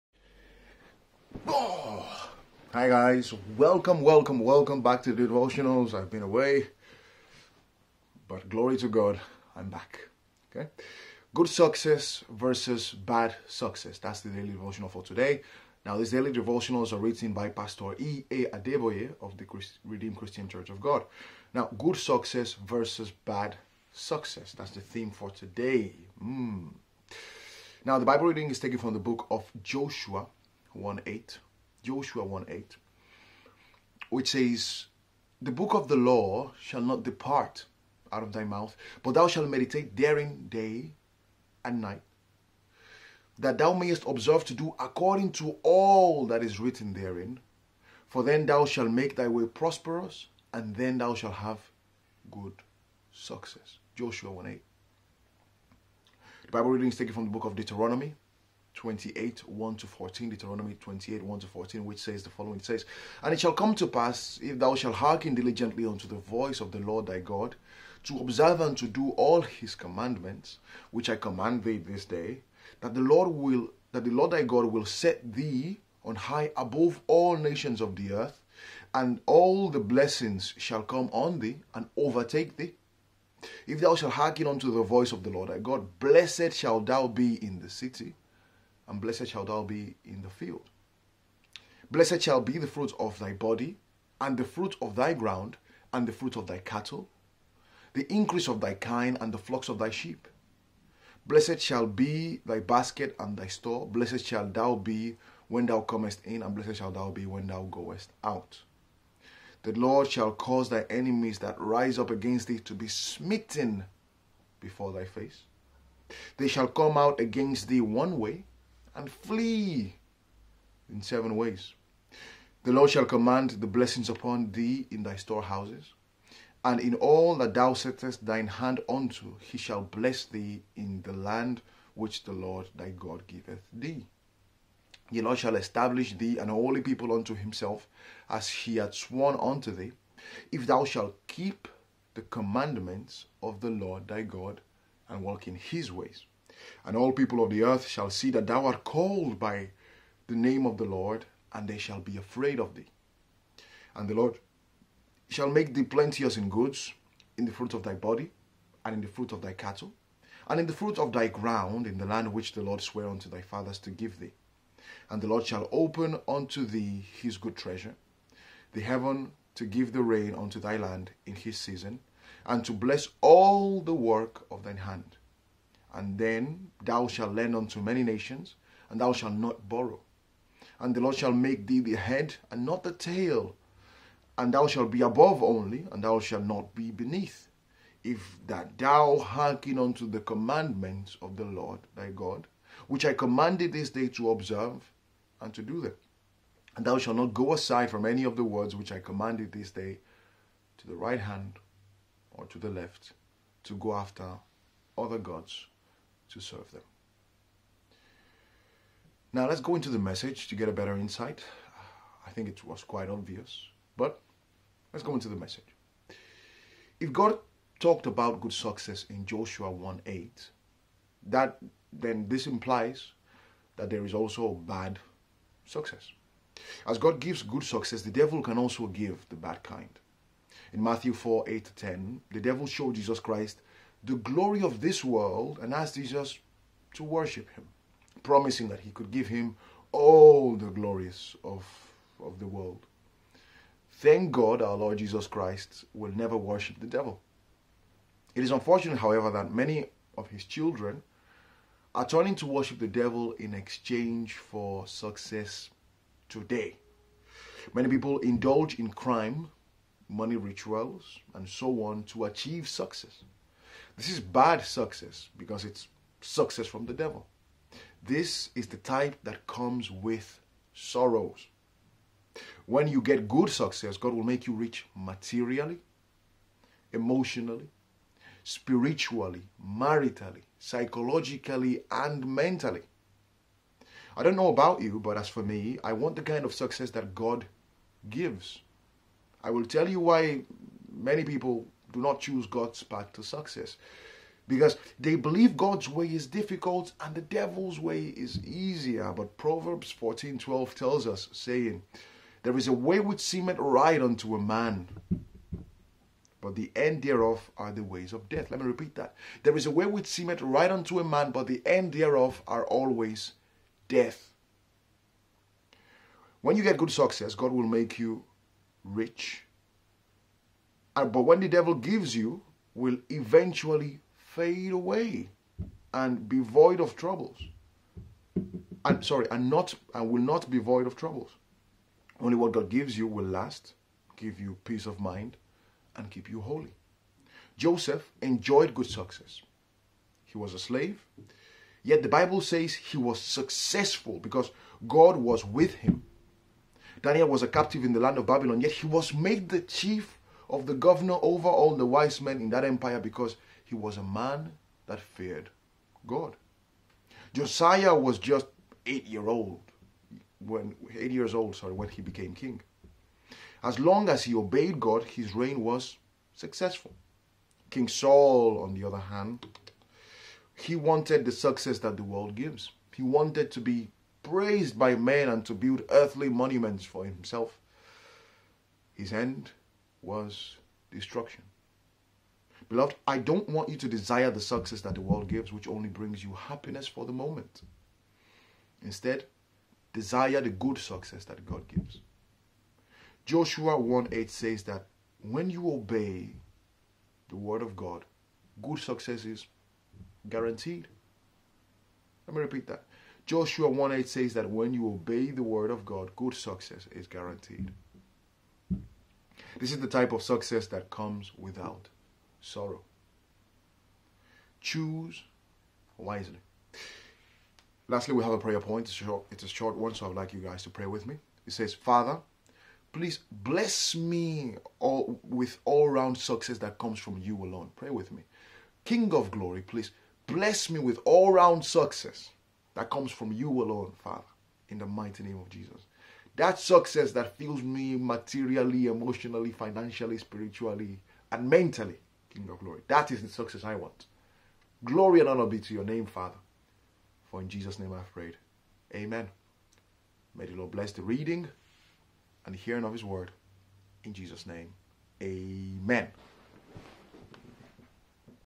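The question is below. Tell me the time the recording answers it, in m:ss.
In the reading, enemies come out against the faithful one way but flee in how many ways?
2:01.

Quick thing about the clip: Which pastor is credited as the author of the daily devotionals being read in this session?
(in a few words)
E. A. Adeboye.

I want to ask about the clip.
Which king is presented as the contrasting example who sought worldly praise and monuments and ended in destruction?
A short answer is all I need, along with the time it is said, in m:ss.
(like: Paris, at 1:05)
Saul, at 6:07.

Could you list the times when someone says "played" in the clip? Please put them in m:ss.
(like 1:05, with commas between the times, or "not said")
not said.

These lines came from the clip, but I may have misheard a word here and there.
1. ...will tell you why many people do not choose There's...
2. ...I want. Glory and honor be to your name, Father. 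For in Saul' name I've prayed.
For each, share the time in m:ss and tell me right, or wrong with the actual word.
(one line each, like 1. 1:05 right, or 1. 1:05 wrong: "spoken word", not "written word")
1. 4:49 wrong: "God", not "There"
2. 7:23 wrong: "Jesus", not "Saul".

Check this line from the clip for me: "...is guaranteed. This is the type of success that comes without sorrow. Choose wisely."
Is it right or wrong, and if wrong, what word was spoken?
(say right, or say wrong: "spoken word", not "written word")
right.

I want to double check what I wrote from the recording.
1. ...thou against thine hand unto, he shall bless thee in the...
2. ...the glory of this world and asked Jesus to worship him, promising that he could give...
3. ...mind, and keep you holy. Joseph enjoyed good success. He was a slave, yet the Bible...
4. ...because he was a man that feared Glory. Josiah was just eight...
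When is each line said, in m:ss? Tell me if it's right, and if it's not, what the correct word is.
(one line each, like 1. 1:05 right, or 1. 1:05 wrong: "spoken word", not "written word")
1. 2:07 wrong: "settest", not "against"
2. 3:54 right
3. 5:34 right
4. 5:52 wrong: "God", not "Glory".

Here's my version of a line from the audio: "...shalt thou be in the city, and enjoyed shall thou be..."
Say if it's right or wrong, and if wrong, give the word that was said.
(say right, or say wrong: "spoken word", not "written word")
wrong: "blessed", not "enjoyed".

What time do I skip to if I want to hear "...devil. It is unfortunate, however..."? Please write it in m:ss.
4:06.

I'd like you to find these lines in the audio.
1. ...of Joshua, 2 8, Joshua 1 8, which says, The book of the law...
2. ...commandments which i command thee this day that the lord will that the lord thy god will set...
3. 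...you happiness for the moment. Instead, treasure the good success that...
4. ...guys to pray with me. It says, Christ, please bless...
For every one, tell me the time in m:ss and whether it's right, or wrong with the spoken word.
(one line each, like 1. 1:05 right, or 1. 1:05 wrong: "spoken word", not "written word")
1. 0:29 wrong: "1", not "2"
2. 1:09 right
3. 6:26 wrong: "desire", not "treasure"
4. 7:00 wrong: "Father", not "Christ".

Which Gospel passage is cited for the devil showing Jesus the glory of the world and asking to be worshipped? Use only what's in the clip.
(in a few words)
Matthew 4:8-10.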